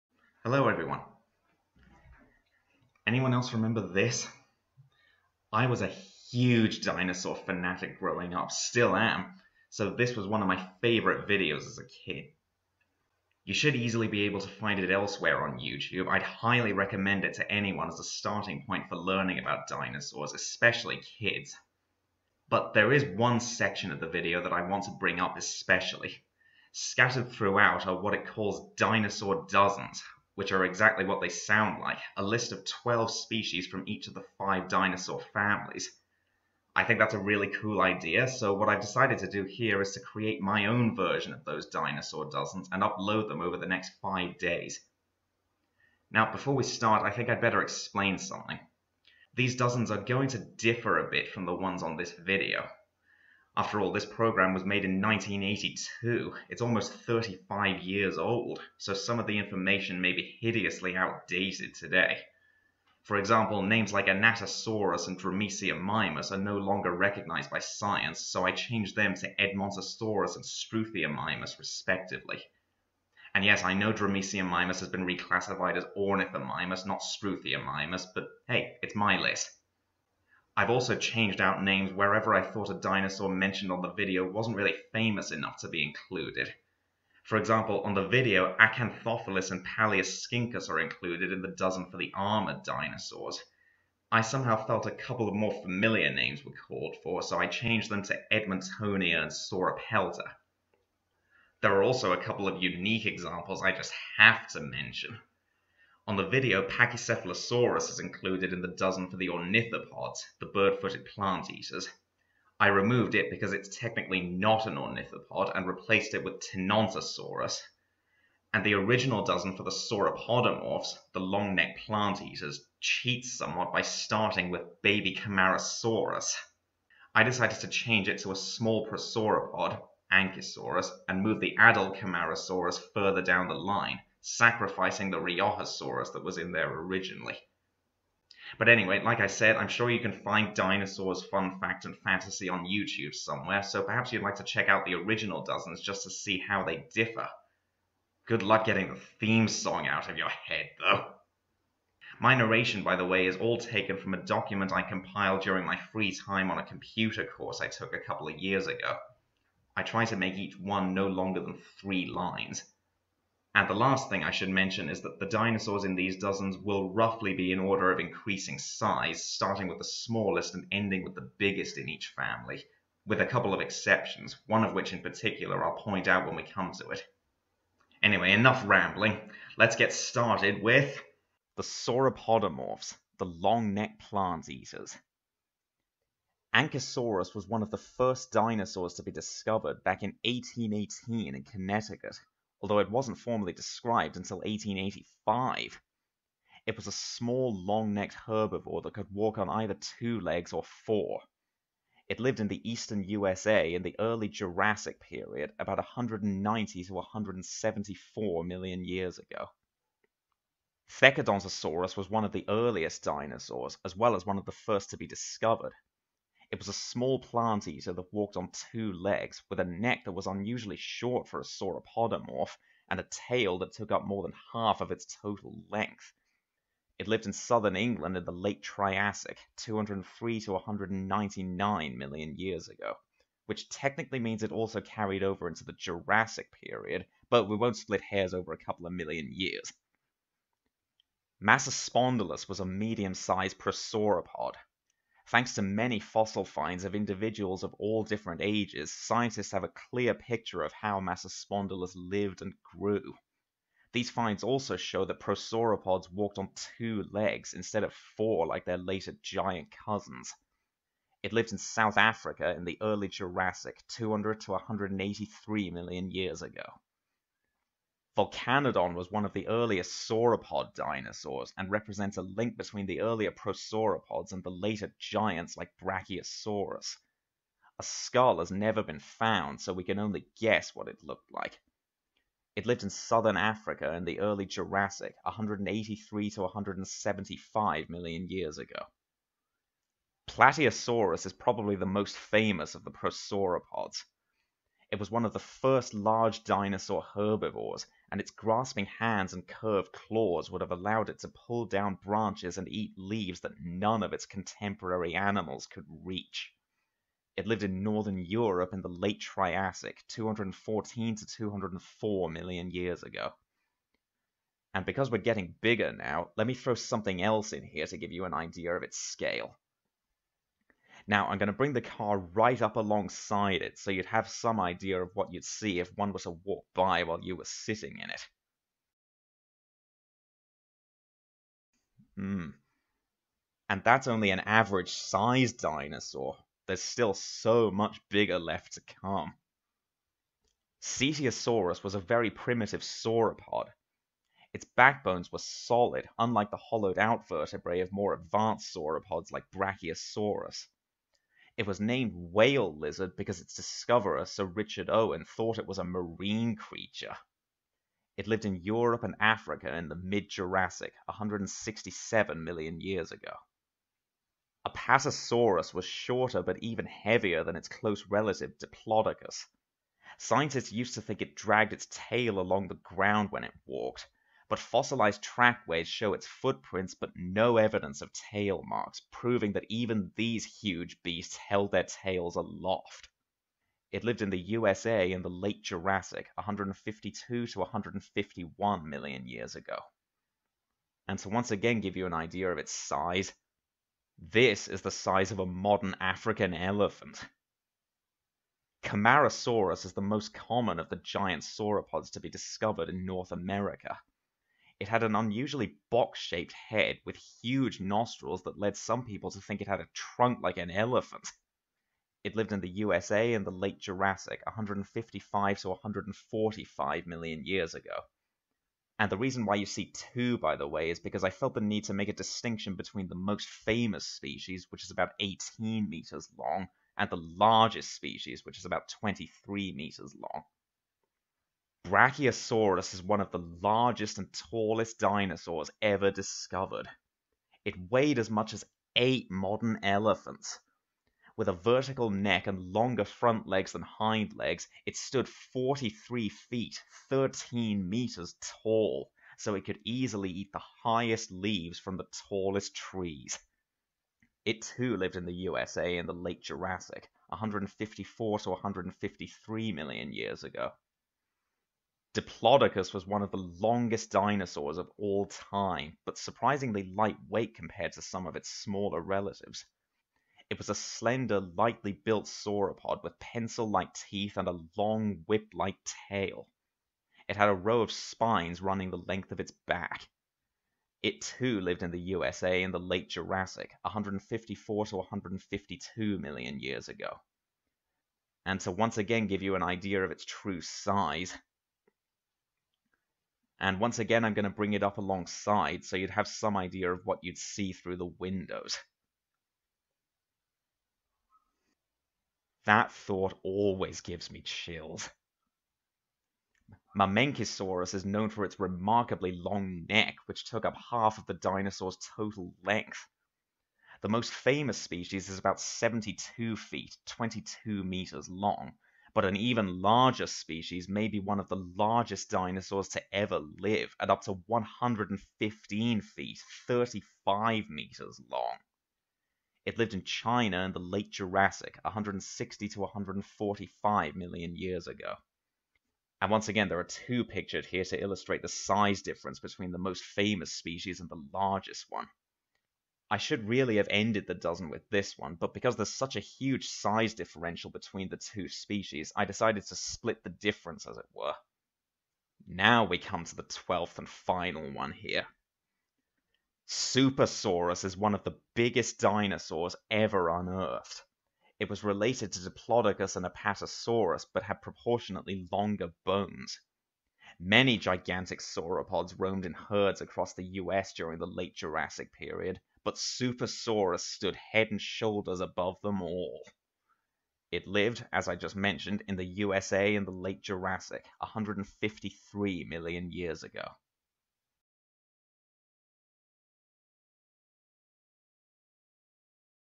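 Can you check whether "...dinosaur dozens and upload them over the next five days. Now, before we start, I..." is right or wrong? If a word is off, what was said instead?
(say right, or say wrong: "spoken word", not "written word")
right.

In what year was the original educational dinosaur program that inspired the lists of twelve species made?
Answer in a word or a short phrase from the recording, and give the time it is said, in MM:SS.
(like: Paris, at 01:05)
1982, at 00:55.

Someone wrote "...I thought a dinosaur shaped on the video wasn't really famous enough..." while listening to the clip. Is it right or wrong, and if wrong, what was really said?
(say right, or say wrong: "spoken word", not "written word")
wrong: "mentioned", not "shaped".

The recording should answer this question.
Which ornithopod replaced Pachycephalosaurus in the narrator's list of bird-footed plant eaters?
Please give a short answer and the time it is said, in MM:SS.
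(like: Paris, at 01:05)
Tenontosaurus, at 01:56.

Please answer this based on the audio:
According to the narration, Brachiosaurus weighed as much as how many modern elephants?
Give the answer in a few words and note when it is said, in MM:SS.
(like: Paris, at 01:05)
8, at 07:18.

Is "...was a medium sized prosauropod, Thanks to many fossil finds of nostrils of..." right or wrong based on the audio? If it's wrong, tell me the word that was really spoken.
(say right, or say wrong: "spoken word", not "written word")
wrong: "individuals", not "nostrils".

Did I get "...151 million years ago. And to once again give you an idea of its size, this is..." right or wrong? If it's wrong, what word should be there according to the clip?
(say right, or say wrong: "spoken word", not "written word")
right.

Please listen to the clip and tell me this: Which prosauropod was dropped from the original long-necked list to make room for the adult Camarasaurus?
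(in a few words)
Riojasaurus.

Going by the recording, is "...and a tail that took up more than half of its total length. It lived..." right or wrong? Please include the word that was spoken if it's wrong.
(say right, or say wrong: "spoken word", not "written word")
right.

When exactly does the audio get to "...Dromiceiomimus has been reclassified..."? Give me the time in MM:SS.
01:13.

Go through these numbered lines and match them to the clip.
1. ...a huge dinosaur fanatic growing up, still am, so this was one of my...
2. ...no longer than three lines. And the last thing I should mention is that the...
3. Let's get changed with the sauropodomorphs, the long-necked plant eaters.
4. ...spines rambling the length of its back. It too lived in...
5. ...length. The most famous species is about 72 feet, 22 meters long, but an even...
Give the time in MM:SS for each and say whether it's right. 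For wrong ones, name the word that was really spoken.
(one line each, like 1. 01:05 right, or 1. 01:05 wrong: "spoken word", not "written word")
1. 00:05 right
2. 02:40 right
3. 02:59 wrong: "started", not "changed"
4. 07:57 wrong: "running", not "rambling"
5. 08:32 right.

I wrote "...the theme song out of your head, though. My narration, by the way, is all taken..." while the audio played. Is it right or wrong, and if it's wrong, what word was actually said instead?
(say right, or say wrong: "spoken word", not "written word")
right.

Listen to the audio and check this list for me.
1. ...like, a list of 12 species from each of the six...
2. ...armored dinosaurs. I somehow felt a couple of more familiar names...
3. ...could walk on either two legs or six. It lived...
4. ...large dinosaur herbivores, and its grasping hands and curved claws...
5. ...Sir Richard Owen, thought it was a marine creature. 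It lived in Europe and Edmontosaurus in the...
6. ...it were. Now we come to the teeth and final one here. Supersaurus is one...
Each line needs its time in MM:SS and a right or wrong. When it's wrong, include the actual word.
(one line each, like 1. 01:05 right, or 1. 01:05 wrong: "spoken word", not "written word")
1. 00:31 wrong: "five", not "six"
2. 01:32 right
3. 03:18 wrong: "four", not "six"
4. 04:55 right
5. 05:54 wrong: "Africa", not "Edmontosaurus"
6. 09:10 wrong: "twelfth", not "teeth".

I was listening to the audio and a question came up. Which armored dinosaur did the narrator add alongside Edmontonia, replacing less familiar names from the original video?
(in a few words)
Sauropelta.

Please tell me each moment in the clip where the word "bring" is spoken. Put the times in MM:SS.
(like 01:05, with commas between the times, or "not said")
00:24, 05:21, 08:14.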